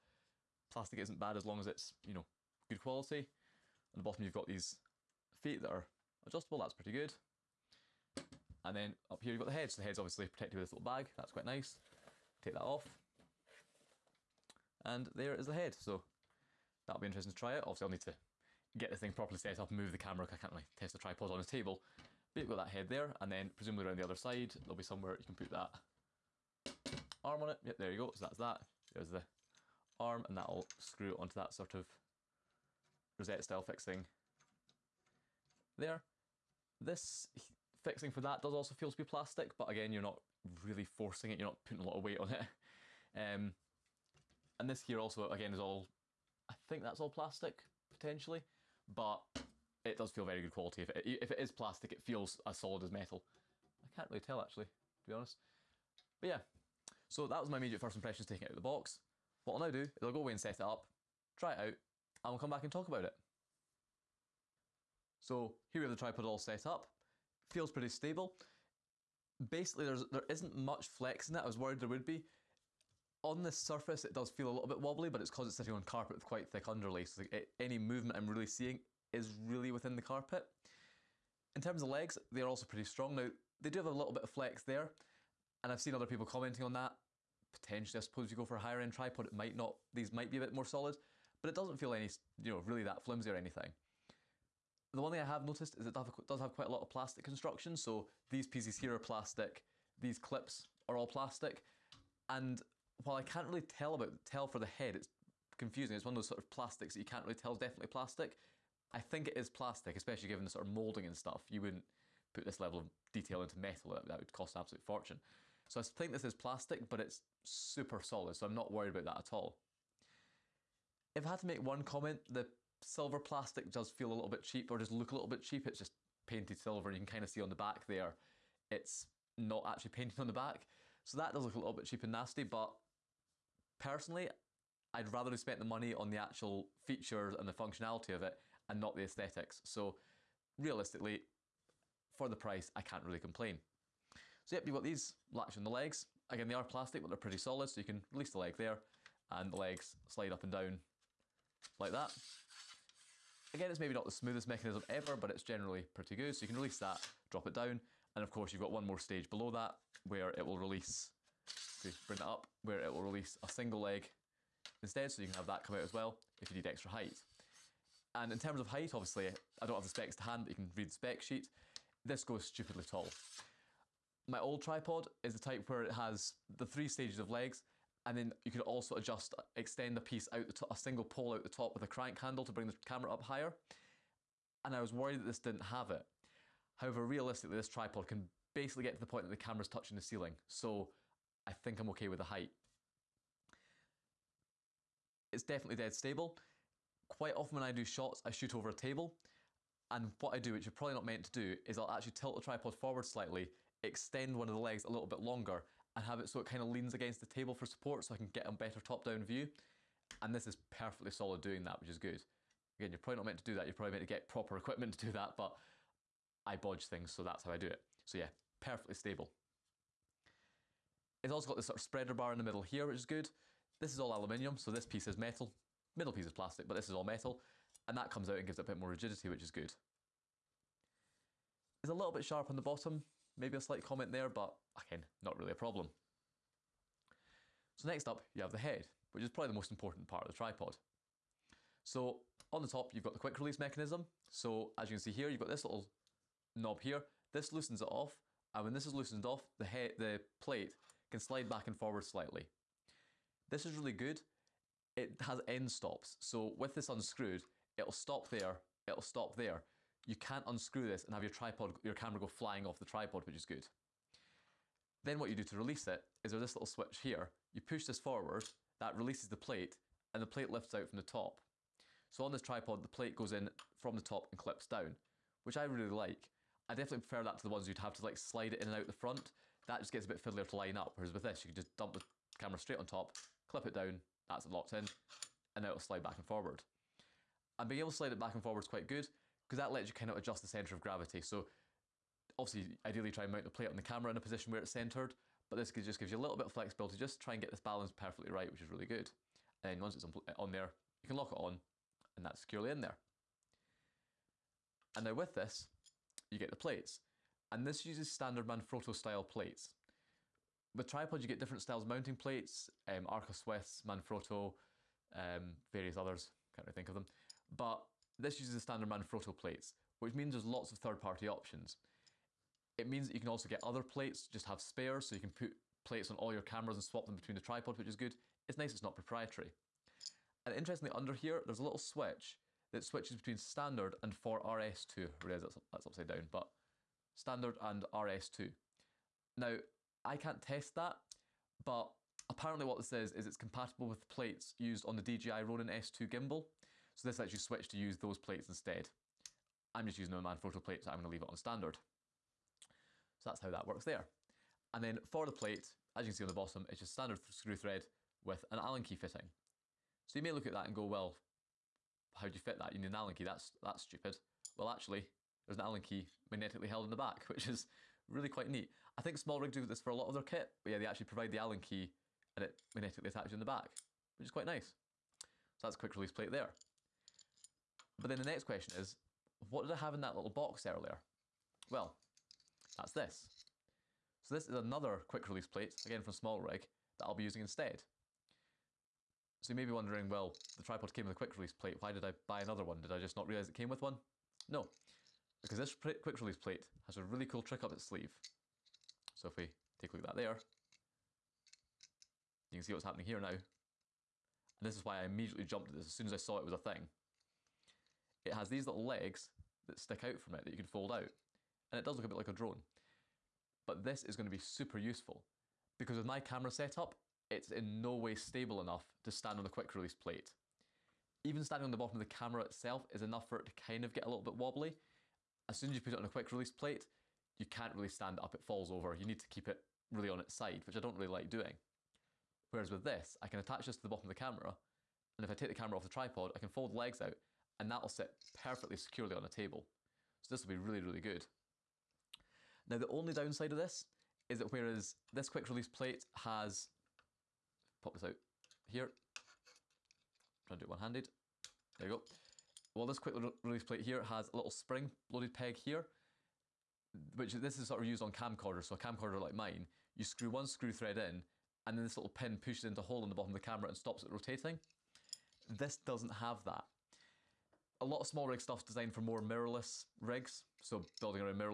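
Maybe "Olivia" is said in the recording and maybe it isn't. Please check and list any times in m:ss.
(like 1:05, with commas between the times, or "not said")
not said.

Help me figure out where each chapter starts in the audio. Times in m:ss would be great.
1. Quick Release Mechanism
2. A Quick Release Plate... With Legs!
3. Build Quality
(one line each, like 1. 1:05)
1. 3:57
2. 6:17
3. 1:04.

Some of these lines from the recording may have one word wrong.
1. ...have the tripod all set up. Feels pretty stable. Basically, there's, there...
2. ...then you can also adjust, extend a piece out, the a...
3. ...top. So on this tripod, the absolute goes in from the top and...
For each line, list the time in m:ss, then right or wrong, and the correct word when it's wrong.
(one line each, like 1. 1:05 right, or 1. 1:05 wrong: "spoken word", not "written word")
1. 1:05 right
2. 2:58 right
3. 4:31 wrong: "plate", not "absolute".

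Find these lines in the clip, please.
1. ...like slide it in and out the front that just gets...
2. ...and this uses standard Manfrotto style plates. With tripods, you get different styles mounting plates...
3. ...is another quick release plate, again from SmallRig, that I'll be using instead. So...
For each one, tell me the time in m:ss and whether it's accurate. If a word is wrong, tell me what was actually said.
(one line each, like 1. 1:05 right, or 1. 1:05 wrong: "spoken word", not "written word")
1. 4:38 right
2. 5:07 right
3. 6:24 right.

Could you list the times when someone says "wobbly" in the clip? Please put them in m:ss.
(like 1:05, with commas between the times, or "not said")
1:14, 7:04.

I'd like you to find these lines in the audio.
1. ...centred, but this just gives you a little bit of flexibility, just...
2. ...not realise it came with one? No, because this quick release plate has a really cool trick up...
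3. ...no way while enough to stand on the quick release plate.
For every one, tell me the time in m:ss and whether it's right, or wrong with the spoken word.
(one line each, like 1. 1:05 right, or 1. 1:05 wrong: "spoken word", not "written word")
1. 4:54 right
2. 6:33 right
3. 6:57 wrong: "stable", not "while".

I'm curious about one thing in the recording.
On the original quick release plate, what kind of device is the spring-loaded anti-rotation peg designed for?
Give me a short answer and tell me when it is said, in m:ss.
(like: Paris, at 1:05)
camcorders, at 7:38.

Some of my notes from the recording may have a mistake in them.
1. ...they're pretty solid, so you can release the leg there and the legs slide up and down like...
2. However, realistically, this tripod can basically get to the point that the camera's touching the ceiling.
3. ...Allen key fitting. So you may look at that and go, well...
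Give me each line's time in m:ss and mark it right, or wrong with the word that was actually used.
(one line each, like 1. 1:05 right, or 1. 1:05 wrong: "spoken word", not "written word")
1. 2:27 right
2. 3:06 right
3. 5:58 right.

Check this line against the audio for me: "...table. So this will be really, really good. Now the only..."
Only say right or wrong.
right.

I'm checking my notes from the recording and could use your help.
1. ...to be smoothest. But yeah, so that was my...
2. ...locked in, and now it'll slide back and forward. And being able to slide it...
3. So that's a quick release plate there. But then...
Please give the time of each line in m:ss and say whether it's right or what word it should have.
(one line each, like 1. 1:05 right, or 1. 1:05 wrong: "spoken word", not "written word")
1. 0:54 wrong: "honest", not "smoothest"
2. 4:44 right
3. 6:15 right.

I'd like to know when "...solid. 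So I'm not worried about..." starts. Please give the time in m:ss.
1:58.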